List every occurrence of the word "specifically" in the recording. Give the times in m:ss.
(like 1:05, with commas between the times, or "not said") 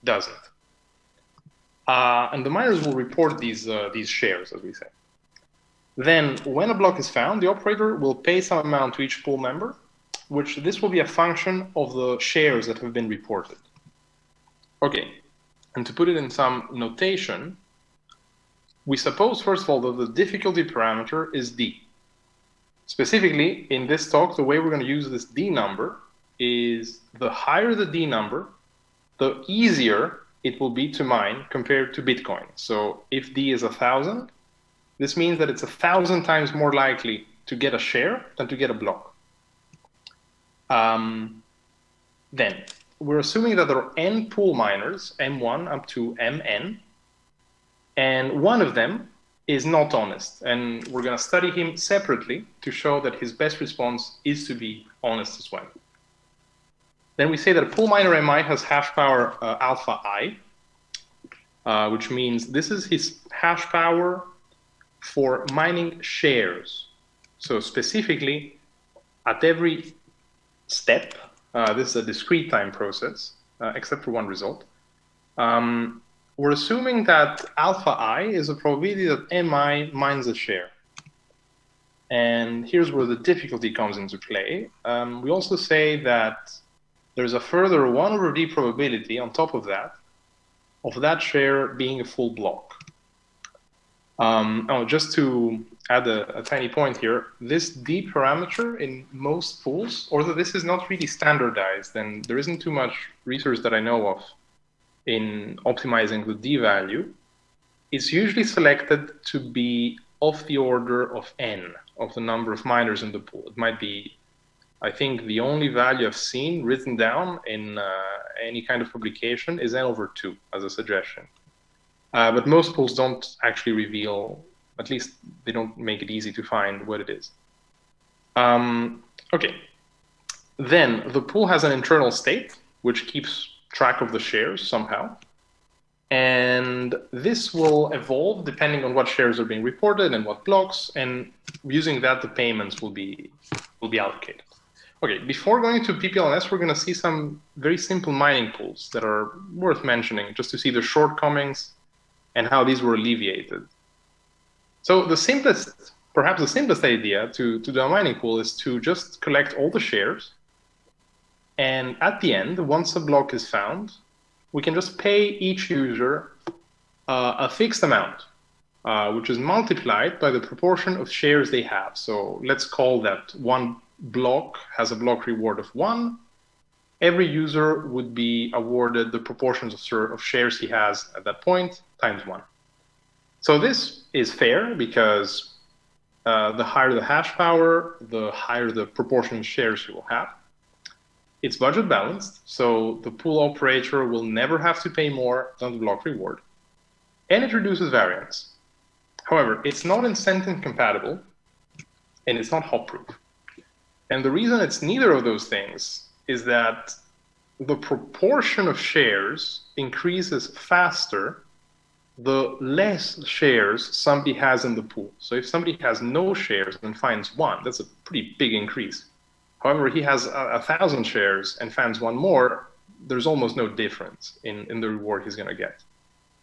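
0:22, 1:07.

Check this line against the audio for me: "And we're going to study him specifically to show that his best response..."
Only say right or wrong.
wrong.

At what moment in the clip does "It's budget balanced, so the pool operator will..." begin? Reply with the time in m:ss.
3:11.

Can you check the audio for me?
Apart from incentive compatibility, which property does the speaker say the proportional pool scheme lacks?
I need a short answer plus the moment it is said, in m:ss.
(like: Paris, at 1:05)
hop proof, at 3:22.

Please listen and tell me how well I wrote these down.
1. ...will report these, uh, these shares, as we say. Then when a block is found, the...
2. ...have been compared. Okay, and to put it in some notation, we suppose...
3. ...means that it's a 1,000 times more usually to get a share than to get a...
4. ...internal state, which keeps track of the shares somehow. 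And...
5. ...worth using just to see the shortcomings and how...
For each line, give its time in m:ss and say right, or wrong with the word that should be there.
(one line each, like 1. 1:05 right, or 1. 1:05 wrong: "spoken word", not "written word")
1. 0:02 right
2. 0:12 wrong: "reported", not "compared"
3. 0:35 wrong: "likely", not "usually"
4. 2:11 right
5. 2:29 wrong: "mentioning", not "using".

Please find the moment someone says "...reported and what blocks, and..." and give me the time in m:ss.
2:19.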